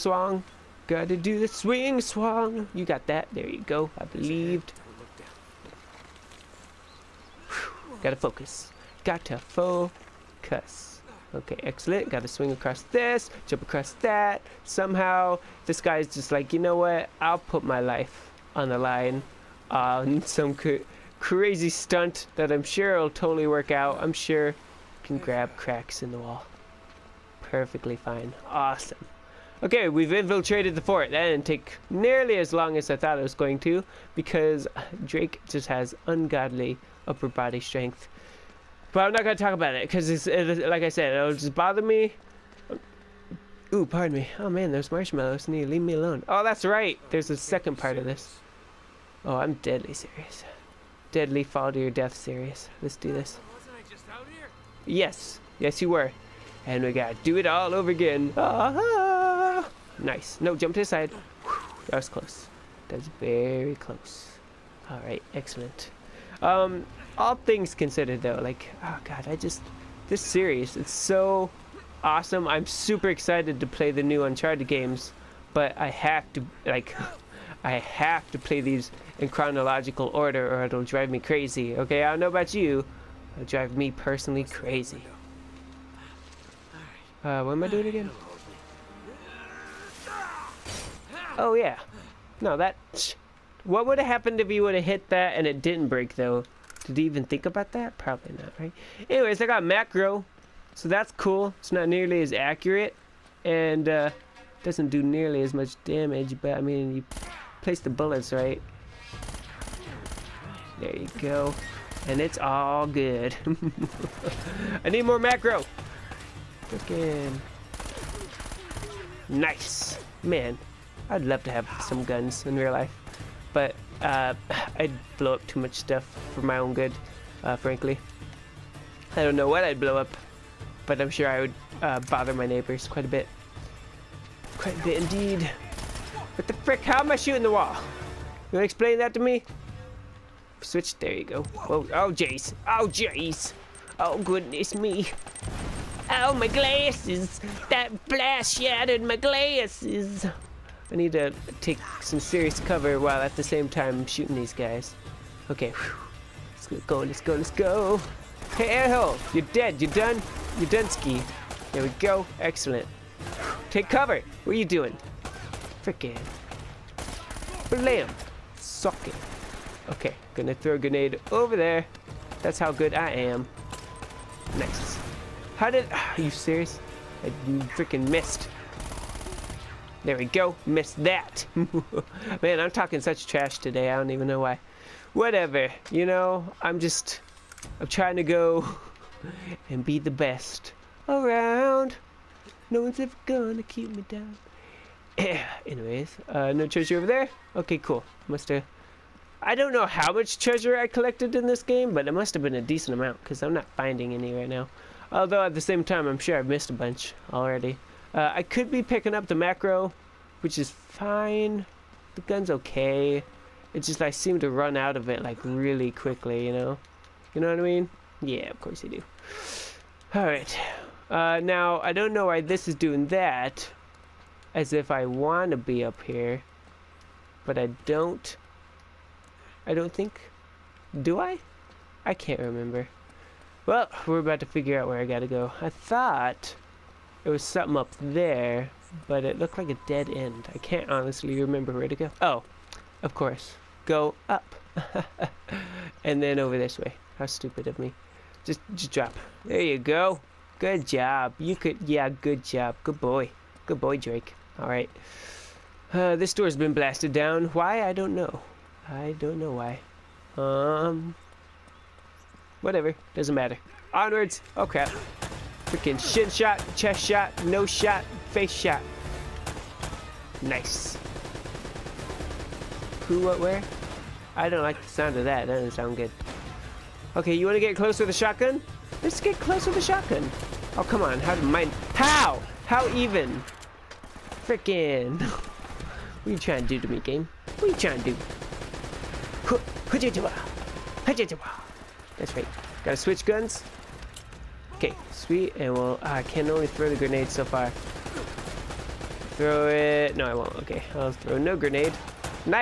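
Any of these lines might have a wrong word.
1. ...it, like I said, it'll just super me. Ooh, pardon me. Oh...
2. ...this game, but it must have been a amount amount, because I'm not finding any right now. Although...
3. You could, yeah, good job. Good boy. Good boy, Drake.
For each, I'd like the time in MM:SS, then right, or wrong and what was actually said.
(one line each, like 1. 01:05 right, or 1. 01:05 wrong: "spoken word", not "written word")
1. 00:40 wrong: "bother", not "super"
2. 03:21 wrong: "decent", not "amount"
3. 04:11 right.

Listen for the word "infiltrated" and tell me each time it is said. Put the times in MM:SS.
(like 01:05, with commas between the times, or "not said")
00:30.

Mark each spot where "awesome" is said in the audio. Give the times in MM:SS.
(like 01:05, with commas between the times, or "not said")
00:28, 01:12.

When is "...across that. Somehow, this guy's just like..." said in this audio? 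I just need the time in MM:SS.
00:13.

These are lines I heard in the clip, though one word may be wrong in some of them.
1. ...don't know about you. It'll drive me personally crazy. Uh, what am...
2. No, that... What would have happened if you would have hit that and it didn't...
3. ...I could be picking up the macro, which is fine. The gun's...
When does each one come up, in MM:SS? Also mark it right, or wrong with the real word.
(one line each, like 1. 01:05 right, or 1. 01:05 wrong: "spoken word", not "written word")
1. 01:22 right
2. 01:32 right
3. 03:28 right.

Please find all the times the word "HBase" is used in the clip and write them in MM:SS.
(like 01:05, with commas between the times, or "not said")
not said.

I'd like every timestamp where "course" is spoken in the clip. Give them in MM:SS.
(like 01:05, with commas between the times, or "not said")
03:38, 04:03.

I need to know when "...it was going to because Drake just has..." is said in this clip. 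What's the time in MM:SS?
00:33.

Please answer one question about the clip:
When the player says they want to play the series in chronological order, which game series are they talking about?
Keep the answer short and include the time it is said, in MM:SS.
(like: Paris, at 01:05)
Uncharted, at 01:14.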